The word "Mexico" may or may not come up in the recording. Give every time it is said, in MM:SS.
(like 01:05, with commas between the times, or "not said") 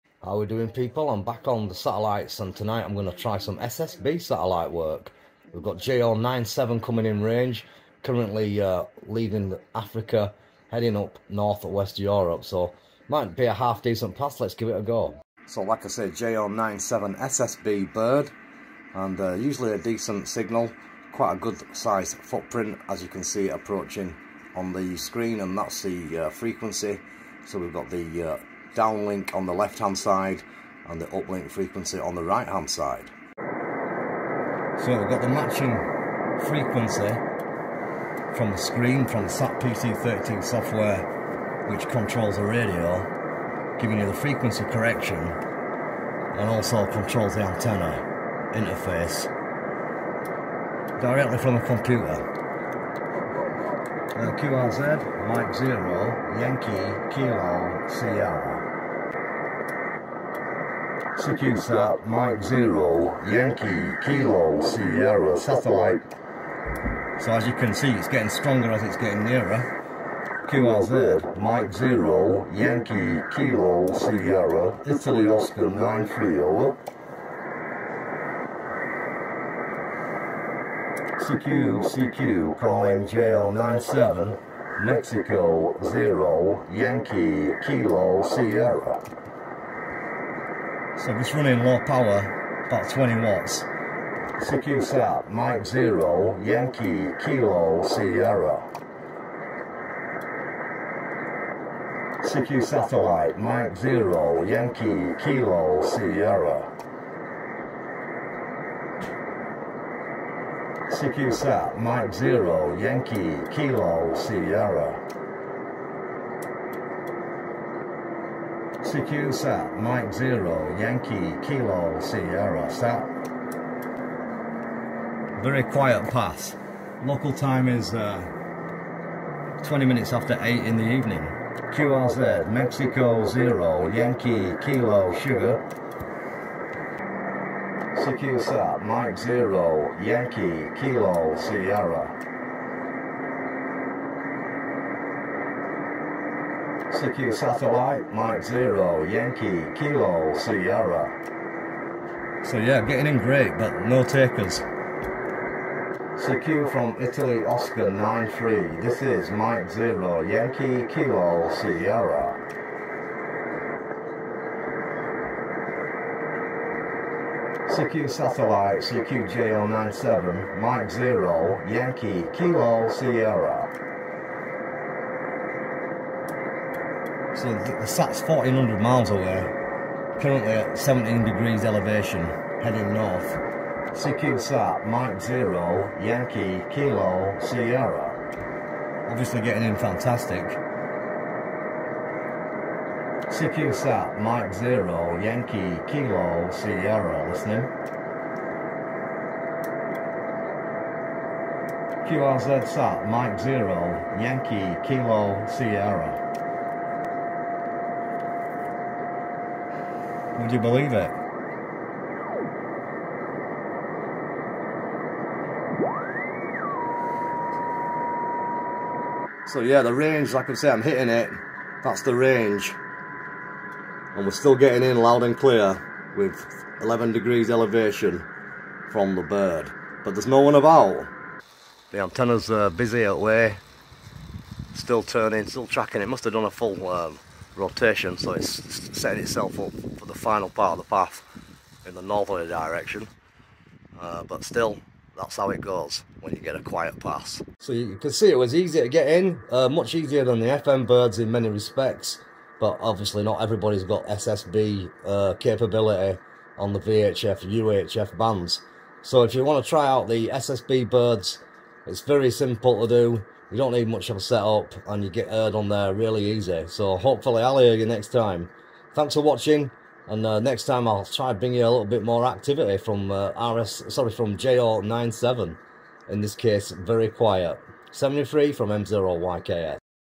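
01:24, 02:12.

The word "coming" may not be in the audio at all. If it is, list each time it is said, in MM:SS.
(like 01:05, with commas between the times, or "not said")
00:06.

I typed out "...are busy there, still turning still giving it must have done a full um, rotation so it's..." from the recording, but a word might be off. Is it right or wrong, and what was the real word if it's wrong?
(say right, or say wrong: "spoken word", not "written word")
wrong: "tracking", not "giving".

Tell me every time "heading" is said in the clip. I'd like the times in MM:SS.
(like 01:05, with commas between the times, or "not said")
00:10, 03:02.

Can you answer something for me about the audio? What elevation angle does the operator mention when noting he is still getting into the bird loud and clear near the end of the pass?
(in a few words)
11 degrees.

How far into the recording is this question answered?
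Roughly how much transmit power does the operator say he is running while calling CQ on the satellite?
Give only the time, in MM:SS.
01:32.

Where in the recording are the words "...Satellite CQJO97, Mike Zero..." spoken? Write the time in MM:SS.
02:48.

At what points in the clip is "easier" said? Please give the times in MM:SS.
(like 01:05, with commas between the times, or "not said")
04:09.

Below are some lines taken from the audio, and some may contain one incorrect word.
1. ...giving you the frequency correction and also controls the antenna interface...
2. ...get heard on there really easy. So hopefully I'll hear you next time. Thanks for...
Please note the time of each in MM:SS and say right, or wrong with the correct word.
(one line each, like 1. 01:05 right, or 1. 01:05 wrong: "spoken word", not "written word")
1. 00:43 right
2. 04:25 right.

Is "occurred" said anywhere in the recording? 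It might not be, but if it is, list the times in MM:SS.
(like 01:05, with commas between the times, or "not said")
not said.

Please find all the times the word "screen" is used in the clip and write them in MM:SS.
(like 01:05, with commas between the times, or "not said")
00:24, 00:38.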